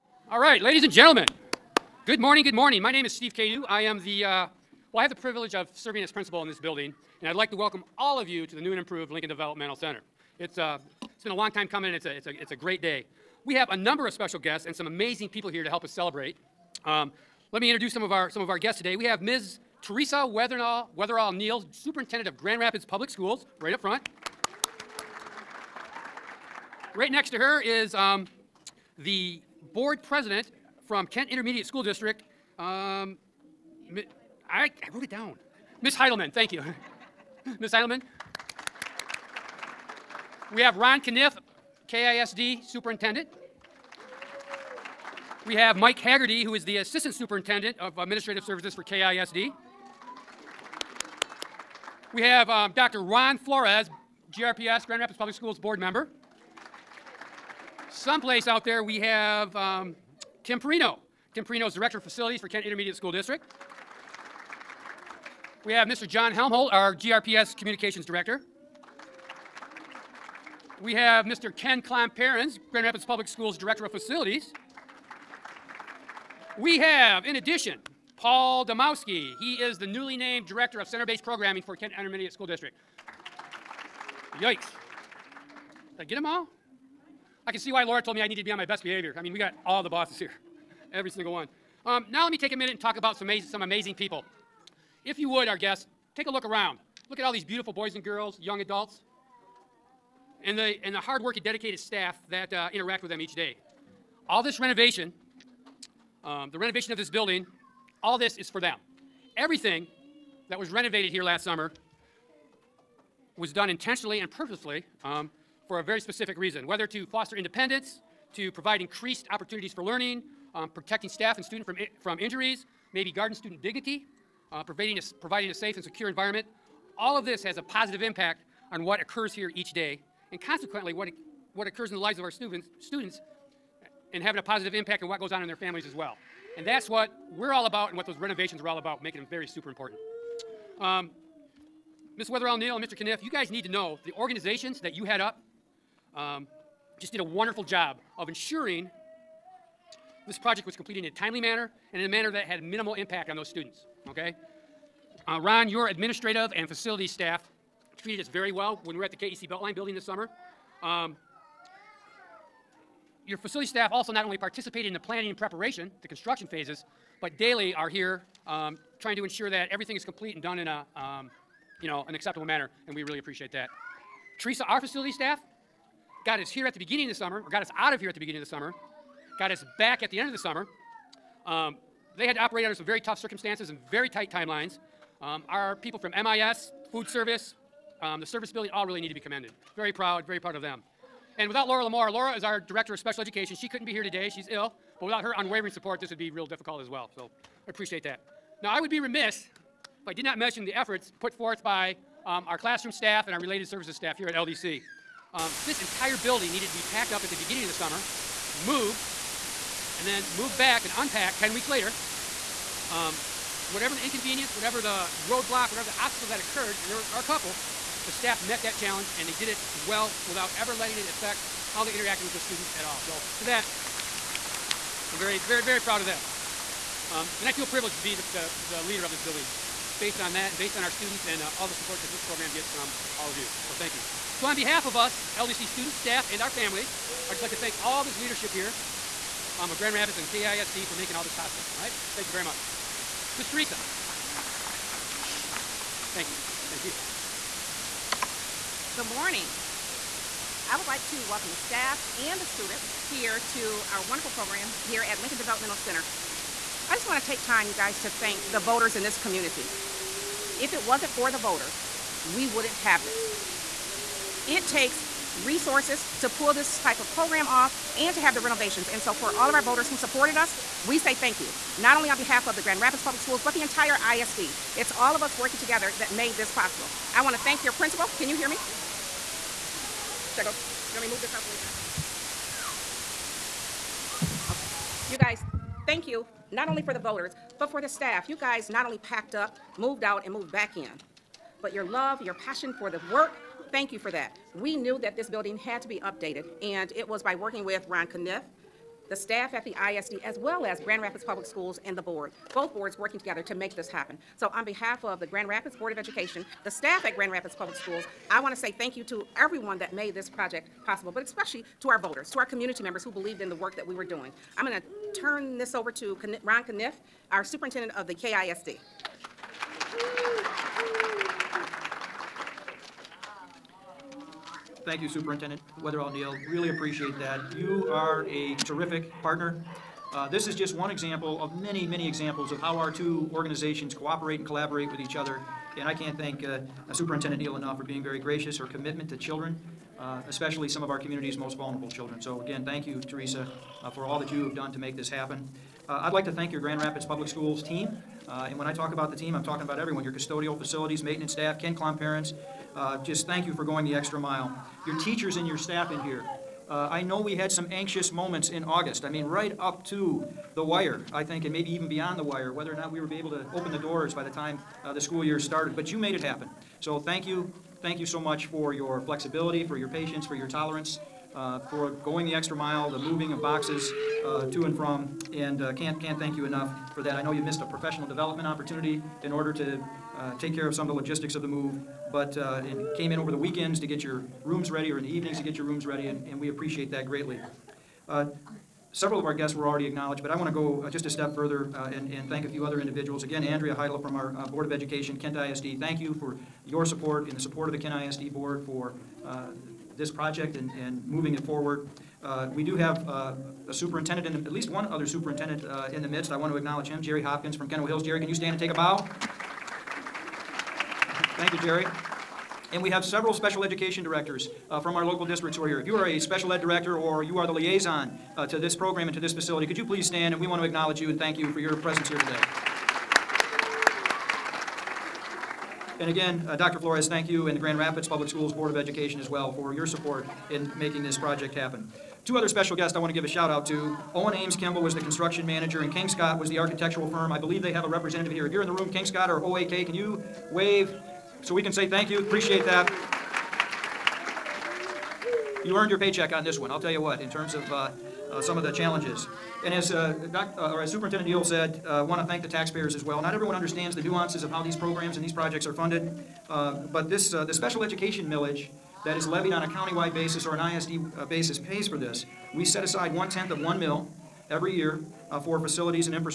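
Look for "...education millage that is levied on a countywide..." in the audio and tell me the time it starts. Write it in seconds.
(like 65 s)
457 s.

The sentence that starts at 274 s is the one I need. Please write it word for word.
It's all of us working together that made this possible.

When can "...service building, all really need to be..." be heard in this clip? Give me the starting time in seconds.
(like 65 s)
188 s.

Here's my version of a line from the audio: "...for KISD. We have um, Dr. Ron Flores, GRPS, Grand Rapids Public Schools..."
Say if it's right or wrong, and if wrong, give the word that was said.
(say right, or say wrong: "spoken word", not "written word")
right.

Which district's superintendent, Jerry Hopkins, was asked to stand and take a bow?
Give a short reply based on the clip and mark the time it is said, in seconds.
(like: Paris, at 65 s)
Kenowa Hills, at 407 s.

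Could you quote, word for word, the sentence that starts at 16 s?
Um, let me introduce some of our, some of our guests today.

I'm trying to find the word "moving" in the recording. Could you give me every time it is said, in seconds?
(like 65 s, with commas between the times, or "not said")
372 s, 401 s.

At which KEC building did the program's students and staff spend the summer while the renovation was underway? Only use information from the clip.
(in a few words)
KEC Beltline.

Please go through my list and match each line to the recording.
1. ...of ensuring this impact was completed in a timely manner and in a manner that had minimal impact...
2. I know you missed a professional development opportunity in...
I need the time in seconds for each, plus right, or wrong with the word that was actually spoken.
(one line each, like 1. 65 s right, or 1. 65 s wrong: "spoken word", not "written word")
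1. 148 s wrong: "project", not "impact"
2. 377 s right.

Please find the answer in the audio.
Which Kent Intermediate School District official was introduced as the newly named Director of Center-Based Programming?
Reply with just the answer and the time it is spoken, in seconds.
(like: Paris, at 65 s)
Paul Domowski, at 78 s.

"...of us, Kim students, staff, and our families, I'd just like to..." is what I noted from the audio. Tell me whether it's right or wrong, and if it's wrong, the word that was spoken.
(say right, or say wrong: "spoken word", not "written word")
wrong: "LDC", not "Kim".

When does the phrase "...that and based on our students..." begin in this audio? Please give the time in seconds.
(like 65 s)
230 s.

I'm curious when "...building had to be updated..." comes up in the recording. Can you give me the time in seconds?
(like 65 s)
295 s.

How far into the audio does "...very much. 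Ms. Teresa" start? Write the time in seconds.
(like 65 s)
242 s.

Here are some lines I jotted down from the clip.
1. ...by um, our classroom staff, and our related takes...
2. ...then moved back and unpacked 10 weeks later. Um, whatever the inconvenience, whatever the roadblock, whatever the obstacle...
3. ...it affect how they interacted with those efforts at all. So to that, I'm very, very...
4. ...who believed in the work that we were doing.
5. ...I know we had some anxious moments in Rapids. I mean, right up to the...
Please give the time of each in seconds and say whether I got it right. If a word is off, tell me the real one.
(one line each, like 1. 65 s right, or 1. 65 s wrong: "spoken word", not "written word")
1. 201 s wrong: "services", not "takes"
2. 210 s right
3. 220 s wrong: "students", not "efforts"
4. 313 s right
5. 356 s wrong: "August", not "Rapids".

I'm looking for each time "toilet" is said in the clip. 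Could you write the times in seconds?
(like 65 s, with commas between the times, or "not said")
not said.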